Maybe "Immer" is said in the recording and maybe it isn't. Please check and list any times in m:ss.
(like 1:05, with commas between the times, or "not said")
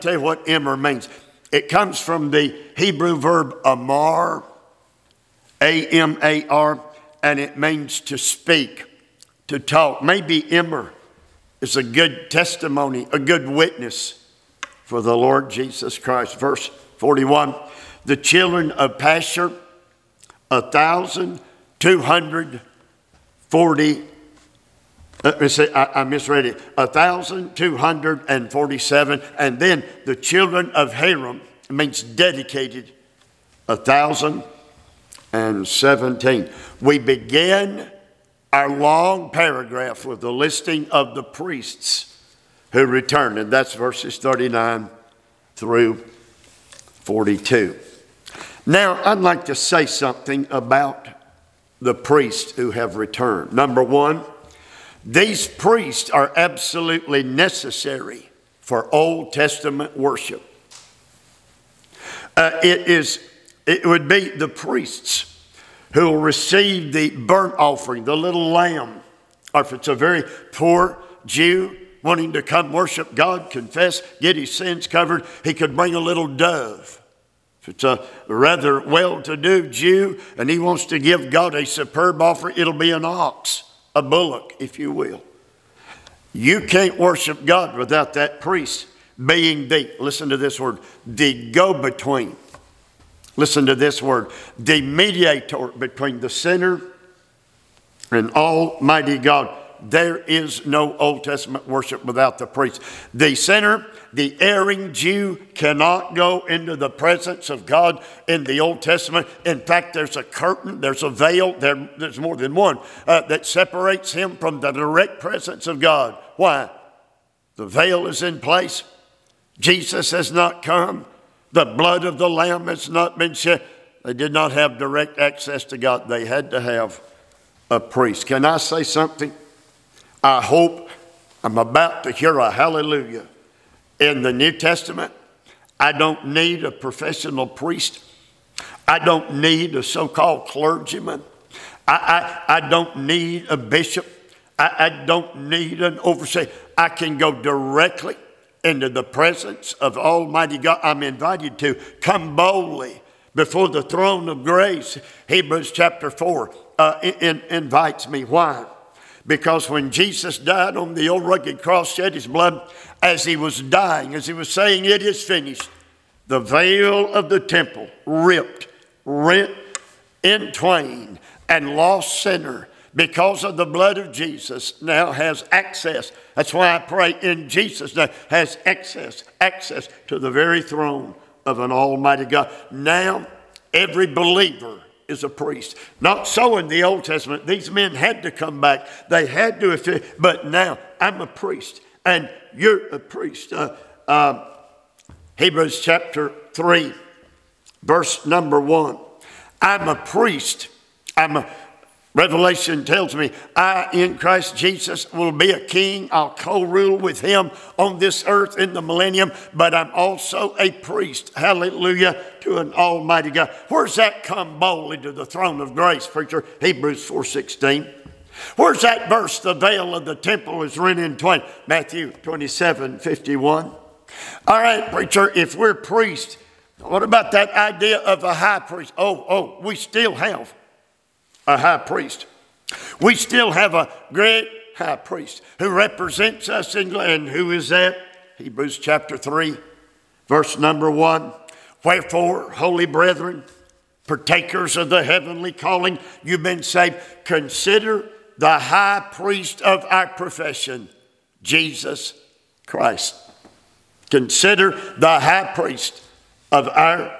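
0:00, 0:10.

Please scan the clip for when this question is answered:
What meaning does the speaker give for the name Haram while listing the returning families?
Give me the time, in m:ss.
0:32.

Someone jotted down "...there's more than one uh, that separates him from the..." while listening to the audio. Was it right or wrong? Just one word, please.
right.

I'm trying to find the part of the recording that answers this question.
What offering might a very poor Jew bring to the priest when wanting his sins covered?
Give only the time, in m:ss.
1:15.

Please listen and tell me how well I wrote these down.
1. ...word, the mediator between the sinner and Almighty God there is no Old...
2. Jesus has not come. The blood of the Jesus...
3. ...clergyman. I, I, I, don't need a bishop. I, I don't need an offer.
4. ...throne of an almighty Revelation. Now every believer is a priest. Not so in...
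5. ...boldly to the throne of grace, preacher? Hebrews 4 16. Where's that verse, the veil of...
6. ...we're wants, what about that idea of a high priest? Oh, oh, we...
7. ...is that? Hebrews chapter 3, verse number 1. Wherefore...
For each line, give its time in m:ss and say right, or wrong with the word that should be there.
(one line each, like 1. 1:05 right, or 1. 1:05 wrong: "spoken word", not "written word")
1. 1:34 right
2. 1:59 wrong: "Lamb", not "Jesus"
3. 2:20 wrong: "overseer", not "offer"
4. 3:00 wrong: "God", not "Revelation"
5. 3:34 right
6. 3:45 wrong: "priests", not "wants"
7. 3:57 right.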